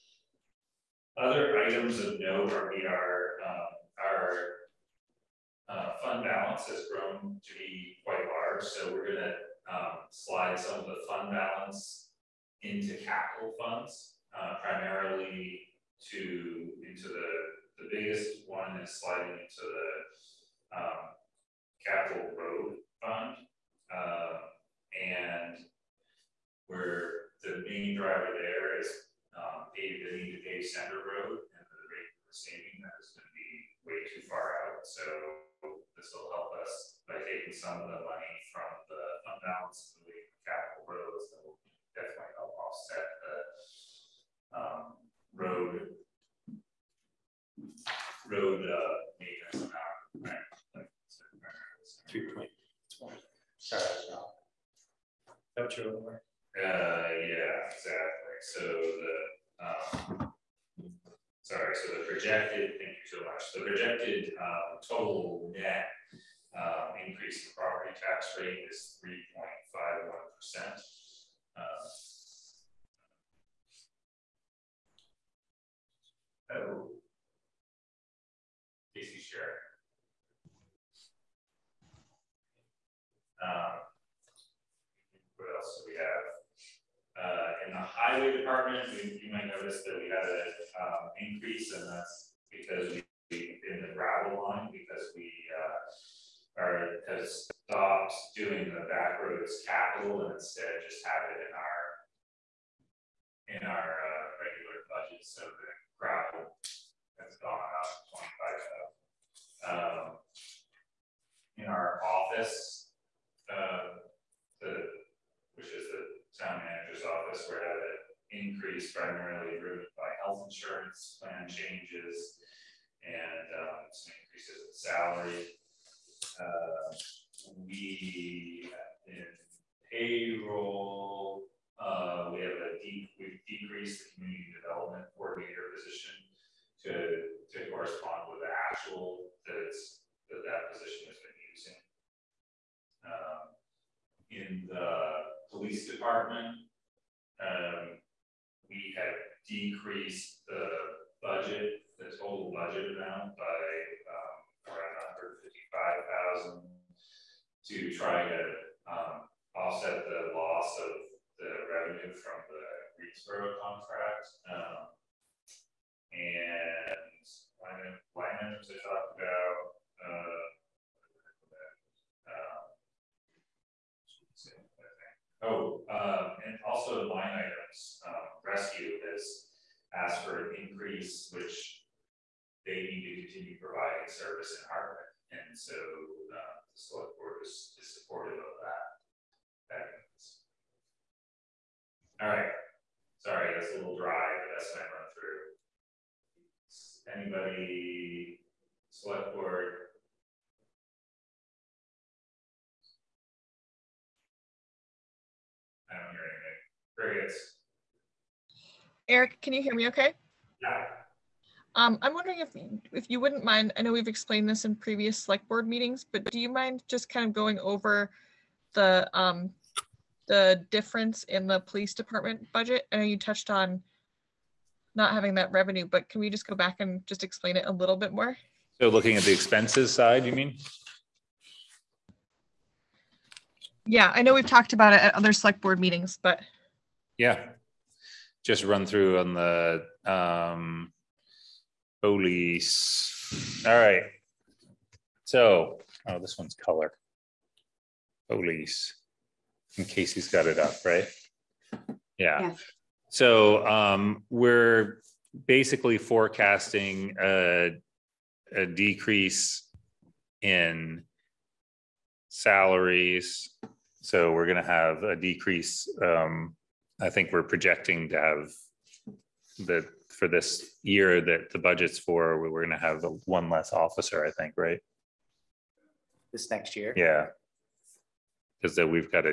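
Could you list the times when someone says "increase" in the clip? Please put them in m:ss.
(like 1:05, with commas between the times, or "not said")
1:07, 1:31, 1:58, 2:04, 3:00.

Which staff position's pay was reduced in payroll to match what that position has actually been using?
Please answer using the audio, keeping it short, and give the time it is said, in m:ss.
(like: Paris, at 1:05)
Community development coordinator, at 2:14.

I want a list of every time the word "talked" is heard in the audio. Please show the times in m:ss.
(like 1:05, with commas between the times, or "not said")
2:48, 3:54.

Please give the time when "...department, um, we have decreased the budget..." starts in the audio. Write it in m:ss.
2:25.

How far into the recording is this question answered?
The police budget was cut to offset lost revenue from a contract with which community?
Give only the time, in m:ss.
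2:42.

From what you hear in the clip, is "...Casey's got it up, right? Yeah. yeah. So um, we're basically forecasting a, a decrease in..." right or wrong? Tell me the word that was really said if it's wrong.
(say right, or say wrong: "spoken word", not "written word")
right.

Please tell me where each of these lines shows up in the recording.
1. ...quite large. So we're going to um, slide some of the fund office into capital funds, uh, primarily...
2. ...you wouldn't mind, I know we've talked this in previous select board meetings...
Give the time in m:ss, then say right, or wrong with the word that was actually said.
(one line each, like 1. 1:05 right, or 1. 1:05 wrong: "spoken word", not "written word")
1. 0:08 wrong: "balance", not "office"
2. 3:33 wrong: "explained", not "talked".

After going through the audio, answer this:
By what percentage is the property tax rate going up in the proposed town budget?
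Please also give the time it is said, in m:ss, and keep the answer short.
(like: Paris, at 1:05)
3.51%, at 1:09.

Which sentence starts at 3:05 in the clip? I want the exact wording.
And so uh, the select board is, is supportive of that.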